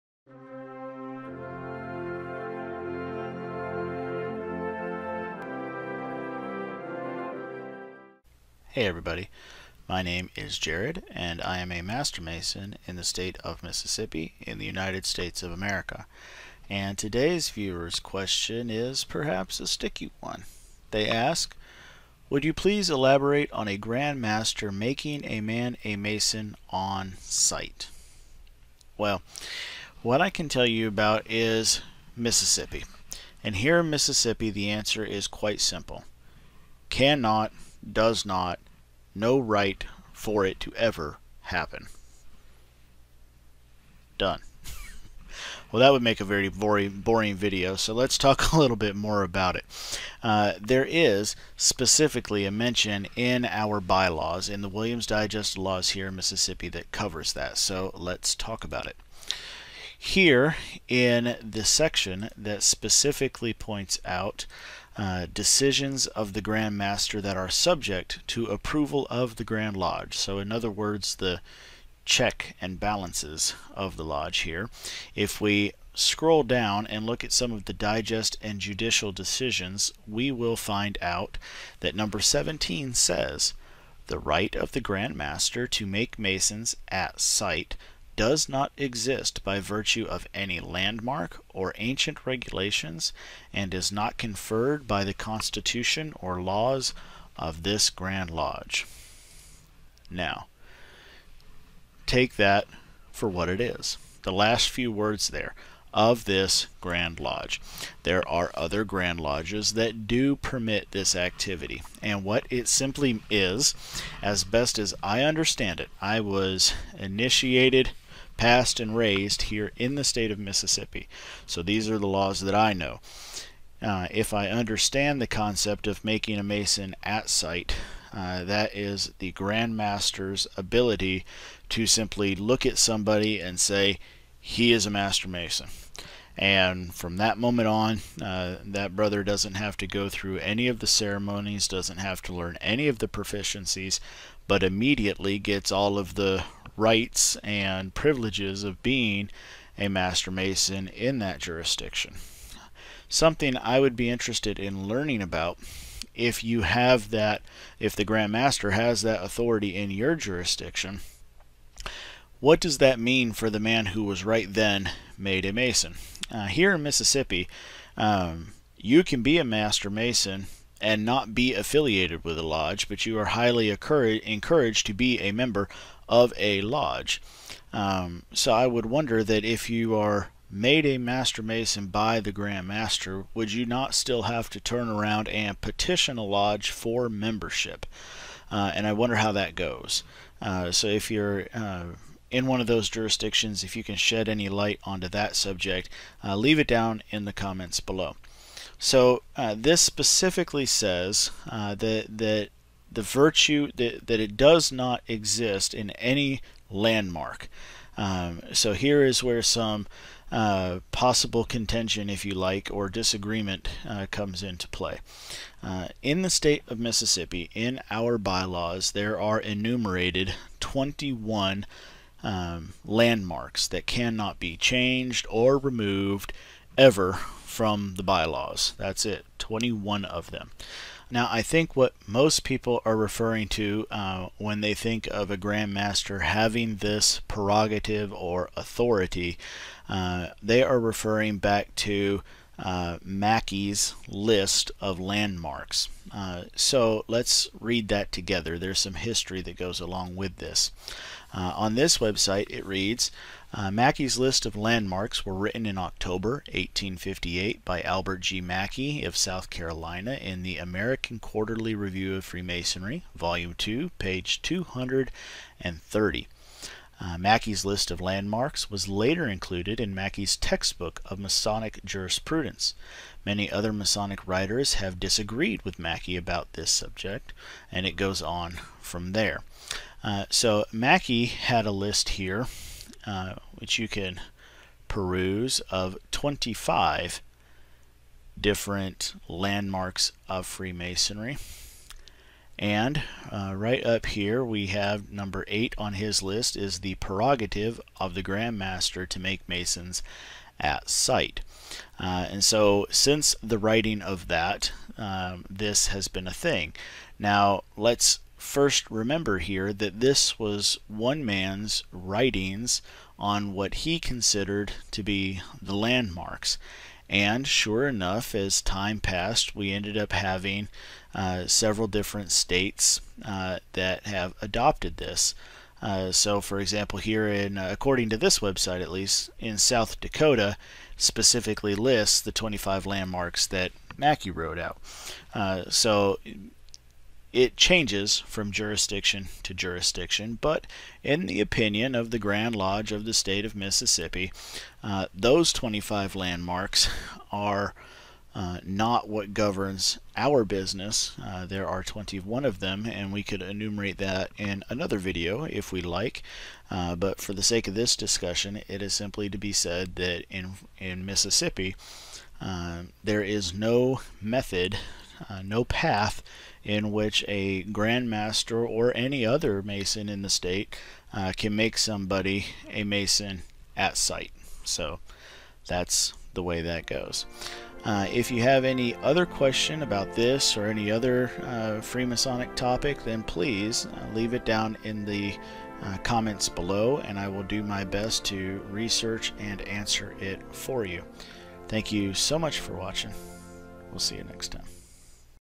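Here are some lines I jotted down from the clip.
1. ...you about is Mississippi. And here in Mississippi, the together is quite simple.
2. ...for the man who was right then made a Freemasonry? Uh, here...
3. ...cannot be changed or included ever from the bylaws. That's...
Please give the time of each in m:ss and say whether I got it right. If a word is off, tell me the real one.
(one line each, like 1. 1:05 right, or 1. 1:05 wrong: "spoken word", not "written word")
1. 0:30 wrong: "answer", not "together"
2. 2:43 wrong: "Mason", not "Freemasonry"
3. 3:43 wrong: "removed", not "included".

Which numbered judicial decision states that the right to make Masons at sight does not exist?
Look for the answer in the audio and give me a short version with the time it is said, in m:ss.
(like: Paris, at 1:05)
17, at 1:21.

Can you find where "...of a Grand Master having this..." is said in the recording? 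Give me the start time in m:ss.
3:55.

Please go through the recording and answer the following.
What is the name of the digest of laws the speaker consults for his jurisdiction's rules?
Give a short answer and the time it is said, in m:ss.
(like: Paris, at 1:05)
Williams Digest, at 0:54.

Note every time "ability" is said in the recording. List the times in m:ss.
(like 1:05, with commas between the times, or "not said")
2:10.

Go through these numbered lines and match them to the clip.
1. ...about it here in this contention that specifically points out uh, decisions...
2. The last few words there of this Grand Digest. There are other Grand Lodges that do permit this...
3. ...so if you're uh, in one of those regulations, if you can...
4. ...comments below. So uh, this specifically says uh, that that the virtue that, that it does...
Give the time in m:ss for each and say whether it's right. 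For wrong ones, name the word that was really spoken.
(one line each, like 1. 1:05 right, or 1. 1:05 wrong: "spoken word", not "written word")
1. 0:58 wrong: "section", not "contention"
2. 1:44 wrong: "Lodge", not "Digest"
3. 3:10 wrong: "jurisdictions", not "regulations"
4. 3:17 right.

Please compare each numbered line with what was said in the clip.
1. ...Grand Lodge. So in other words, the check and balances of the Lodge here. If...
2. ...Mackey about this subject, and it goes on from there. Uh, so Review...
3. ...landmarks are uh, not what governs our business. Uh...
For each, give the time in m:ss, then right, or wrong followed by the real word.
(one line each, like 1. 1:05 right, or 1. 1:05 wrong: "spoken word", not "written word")
1. 1:09 right
2. 4:35 wrong: "Mackey", not "Review"
3. 5:46 right.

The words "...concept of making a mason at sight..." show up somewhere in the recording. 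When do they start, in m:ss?
2:05.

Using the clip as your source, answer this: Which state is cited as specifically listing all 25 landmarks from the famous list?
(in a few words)
South Dakota.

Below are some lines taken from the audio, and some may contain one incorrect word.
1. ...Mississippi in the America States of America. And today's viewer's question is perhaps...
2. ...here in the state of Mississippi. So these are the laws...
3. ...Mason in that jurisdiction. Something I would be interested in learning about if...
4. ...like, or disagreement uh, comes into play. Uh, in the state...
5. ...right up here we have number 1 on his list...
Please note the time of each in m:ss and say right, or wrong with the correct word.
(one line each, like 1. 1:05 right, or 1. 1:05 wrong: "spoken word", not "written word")
1. 0:13 wrong: "United", not "America"
2. 1:59 right
3. 2:30 right
4. 3:32 right
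5. 4:53 wrong: "8", not "1".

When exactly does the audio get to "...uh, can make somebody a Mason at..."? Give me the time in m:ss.
6:11.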